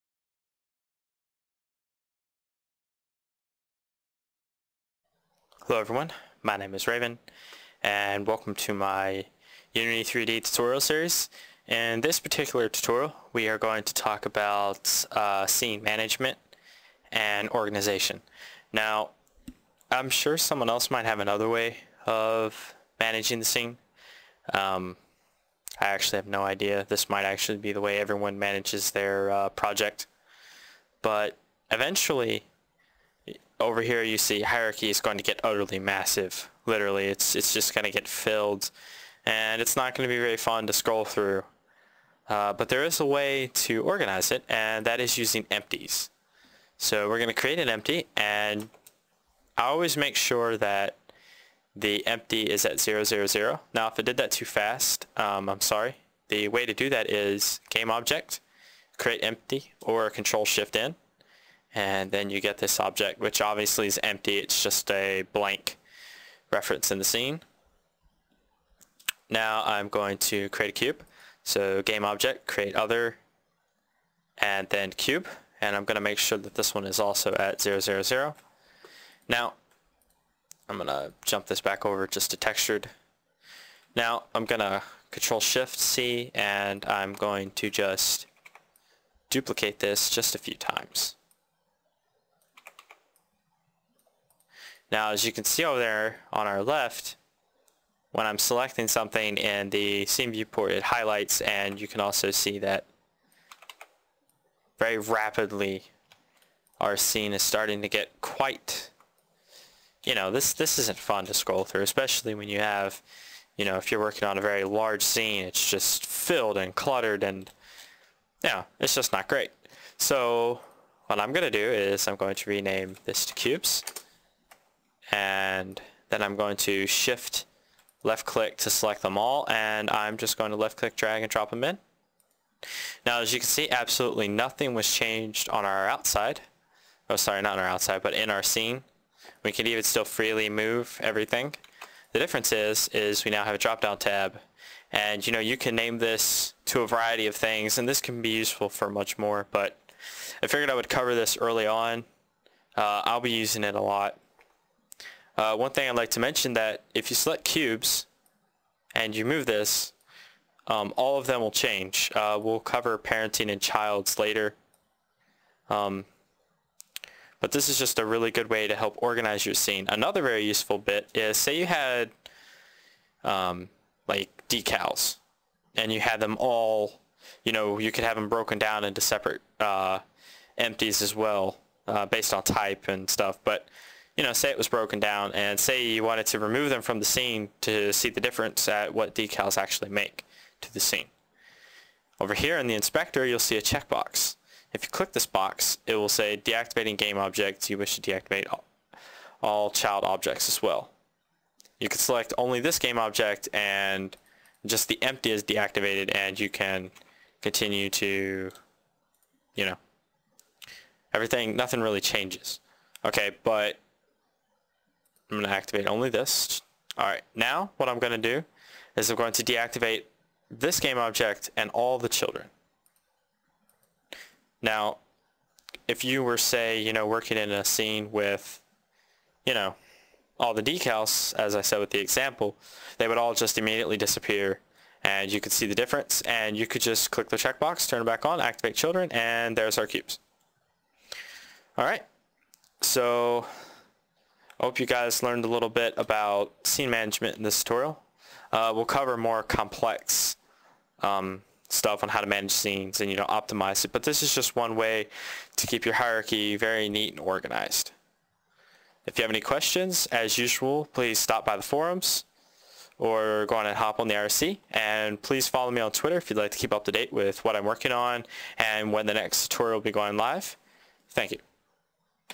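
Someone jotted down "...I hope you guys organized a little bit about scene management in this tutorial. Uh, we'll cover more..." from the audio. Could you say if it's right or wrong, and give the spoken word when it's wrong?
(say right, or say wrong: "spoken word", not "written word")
wrong: "learned", not "organized".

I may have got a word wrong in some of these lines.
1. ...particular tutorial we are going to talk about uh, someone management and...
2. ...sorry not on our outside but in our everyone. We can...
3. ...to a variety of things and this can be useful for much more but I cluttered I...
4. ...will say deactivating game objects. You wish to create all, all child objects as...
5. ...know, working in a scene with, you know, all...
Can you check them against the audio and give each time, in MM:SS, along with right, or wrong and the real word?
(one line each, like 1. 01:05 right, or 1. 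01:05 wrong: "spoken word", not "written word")
1. 00:12 wrong: "scene", not "someone"
2. 02:17 wrong: "scene", not "everyone"
3. 02:26 wrong: "figured", not "cluttered"
4. 03:15 wrong: "deactivate", not "create"
5. 03:46 right.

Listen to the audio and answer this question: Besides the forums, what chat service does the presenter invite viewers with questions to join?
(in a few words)
IRC.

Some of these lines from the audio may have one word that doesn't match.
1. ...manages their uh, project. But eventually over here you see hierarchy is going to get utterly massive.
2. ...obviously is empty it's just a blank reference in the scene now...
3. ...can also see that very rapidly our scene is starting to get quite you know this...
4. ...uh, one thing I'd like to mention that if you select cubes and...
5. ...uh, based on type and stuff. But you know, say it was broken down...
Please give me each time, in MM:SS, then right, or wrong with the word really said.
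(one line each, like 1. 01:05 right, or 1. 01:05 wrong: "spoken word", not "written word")
1. 00:28 right
2. 01:03 right
3. 01:41 right
4. 02:35 right
5. 03:01 right.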